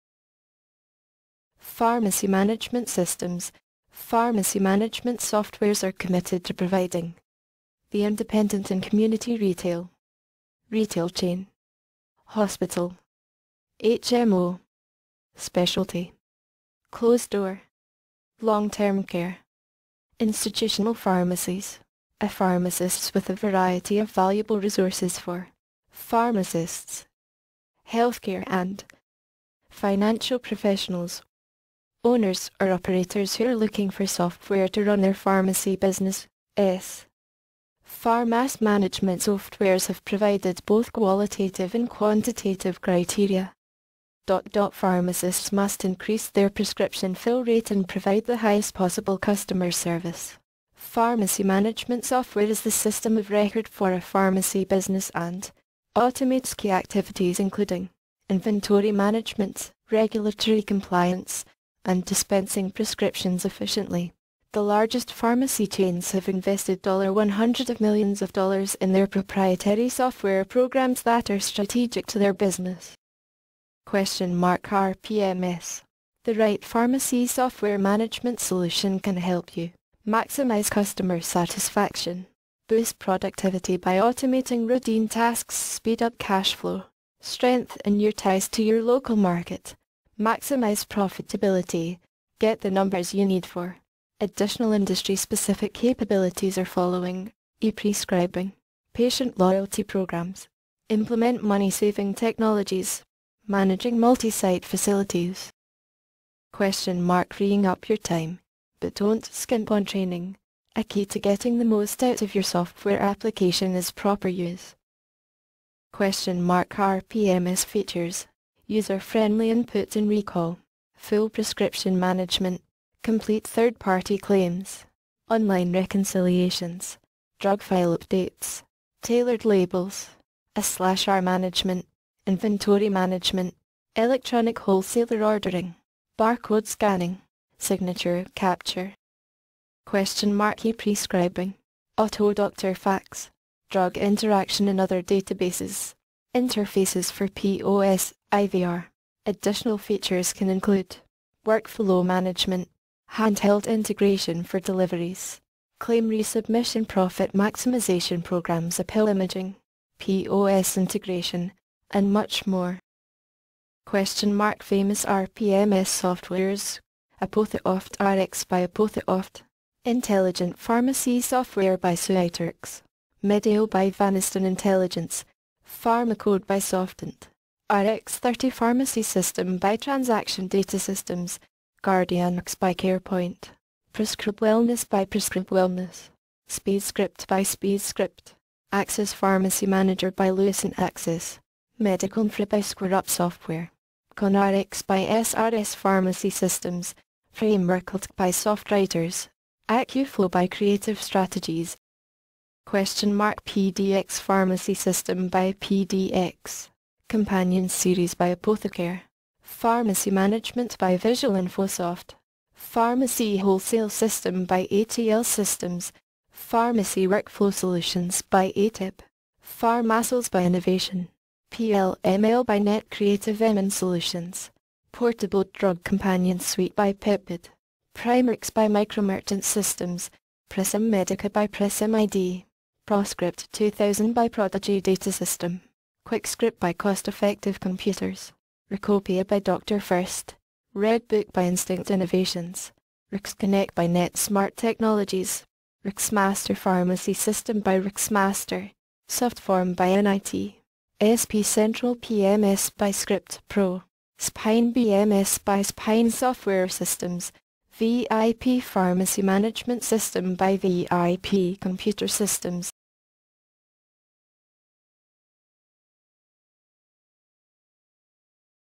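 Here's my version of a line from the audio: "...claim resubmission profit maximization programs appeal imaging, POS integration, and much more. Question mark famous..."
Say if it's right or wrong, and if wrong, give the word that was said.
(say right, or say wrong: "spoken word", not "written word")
right.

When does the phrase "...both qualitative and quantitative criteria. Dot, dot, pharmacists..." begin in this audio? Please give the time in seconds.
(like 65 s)
40 s.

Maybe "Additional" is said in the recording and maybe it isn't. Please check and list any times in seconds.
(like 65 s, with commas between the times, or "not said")
94 s, 149 s.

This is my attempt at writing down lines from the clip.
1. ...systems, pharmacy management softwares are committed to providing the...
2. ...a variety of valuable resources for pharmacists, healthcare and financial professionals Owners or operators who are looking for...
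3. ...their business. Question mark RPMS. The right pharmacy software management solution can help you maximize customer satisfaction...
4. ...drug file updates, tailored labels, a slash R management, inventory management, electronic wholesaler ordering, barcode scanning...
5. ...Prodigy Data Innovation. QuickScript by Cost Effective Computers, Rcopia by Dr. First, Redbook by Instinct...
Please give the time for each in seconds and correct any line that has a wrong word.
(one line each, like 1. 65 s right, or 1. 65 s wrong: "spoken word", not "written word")
1. 2 s right
2. 23 s right
3. 72 s right
4. 127 s right
5. 234 s wrong: "System", not "Innovation".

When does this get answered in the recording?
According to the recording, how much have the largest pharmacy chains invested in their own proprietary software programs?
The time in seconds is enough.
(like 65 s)
66 s.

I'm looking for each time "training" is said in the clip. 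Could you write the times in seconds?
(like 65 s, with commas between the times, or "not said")
109 s.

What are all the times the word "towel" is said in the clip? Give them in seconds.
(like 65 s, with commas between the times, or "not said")
not said.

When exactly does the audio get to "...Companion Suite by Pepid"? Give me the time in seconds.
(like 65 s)
225 s.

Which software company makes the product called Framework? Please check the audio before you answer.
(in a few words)
SoftWriters.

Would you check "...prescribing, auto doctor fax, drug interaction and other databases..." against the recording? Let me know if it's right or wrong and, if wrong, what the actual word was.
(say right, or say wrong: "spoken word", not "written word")
right.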